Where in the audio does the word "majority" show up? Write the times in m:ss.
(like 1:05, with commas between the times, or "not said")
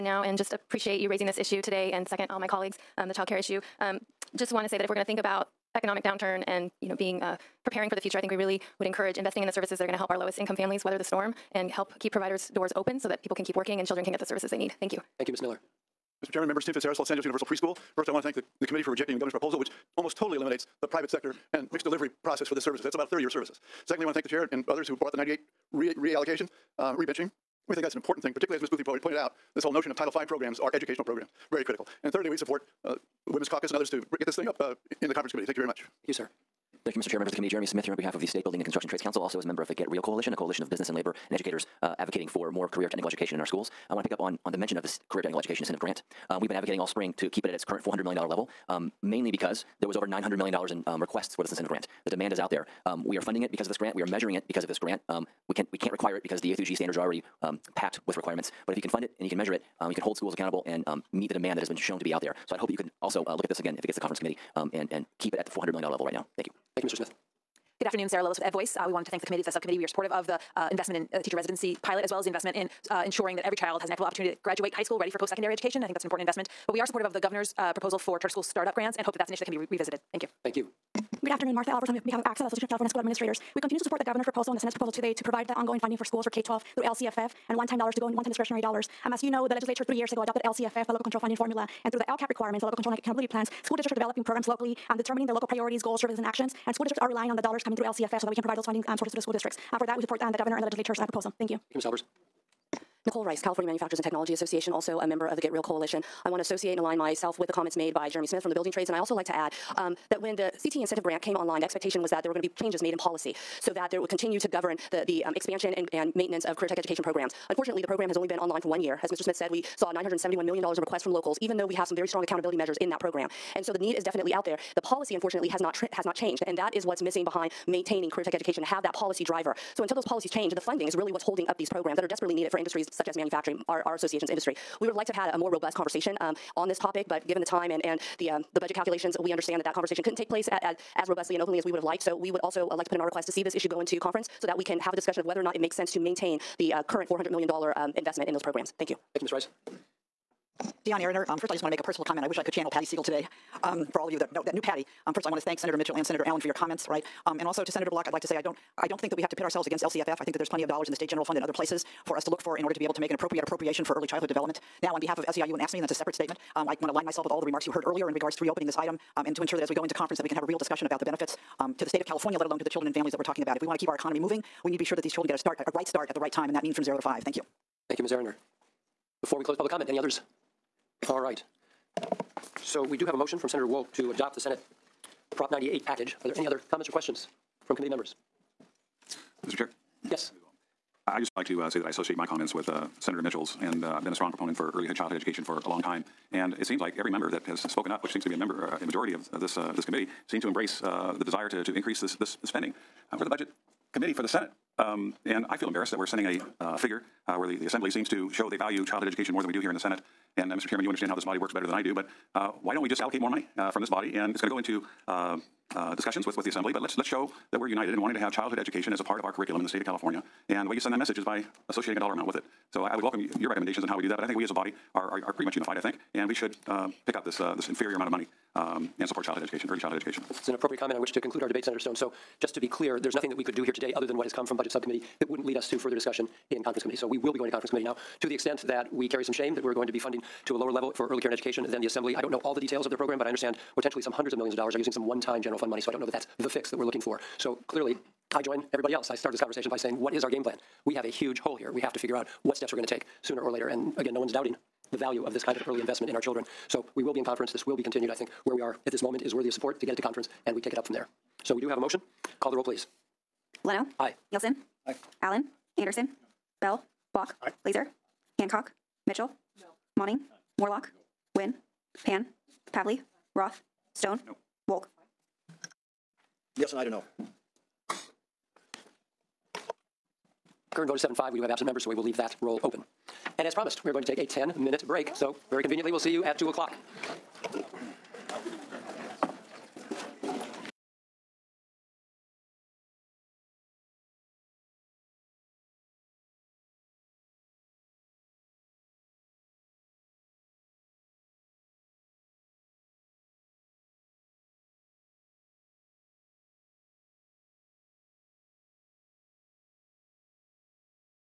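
3:18.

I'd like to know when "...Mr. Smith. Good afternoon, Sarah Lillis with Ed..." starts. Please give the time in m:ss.
1:06.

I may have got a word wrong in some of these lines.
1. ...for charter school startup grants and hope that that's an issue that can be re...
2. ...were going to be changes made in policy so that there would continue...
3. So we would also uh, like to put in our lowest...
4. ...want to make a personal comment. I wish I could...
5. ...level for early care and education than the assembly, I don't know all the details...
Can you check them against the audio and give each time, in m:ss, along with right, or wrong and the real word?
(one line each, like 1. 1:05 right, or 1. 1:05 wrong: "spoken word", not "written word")
1. 1:17 right
2. 1:52 right
3. 2:22 wrong: "request", not "lowest"
4. 2:31 right
5. 4:00 right.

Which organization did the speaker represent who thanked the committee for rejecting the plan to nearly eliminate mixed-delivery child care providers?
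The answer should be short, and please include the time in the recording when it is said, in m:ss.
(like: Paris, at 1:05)
Los Angeles Universal Preschool, at 0:16.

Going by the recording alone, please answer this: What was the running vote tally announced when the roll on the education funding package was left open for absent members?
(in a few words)
7-5.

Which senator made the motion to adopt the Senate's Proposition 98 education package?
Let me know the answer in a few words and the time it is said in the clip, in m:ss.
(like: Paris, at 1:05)
Senator Wolk, at 3:03.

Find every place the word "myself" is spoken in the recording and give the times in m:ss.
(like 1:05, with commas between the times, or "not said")
1:46, 2:47.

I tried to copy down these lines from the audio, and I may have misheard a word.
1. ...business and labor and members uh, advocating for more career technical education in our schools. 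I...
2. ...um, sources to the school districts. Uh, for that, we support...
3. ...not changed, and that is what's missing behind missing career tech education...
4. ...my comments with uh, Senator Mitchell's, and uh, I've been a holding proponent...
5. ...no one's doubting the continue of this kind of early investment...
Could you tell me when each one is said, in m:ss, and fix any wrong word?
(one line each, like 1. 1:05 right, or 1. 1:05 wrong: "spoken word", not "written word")
1. 0:40 wrong: "educators", not "members"
2. 1:38 right
3. 2:06 wrong: "maintaining", not "missing"
4. 3:12 wrong: "strong", not "holding"
5. 4:14 wrong: "value", not "continue".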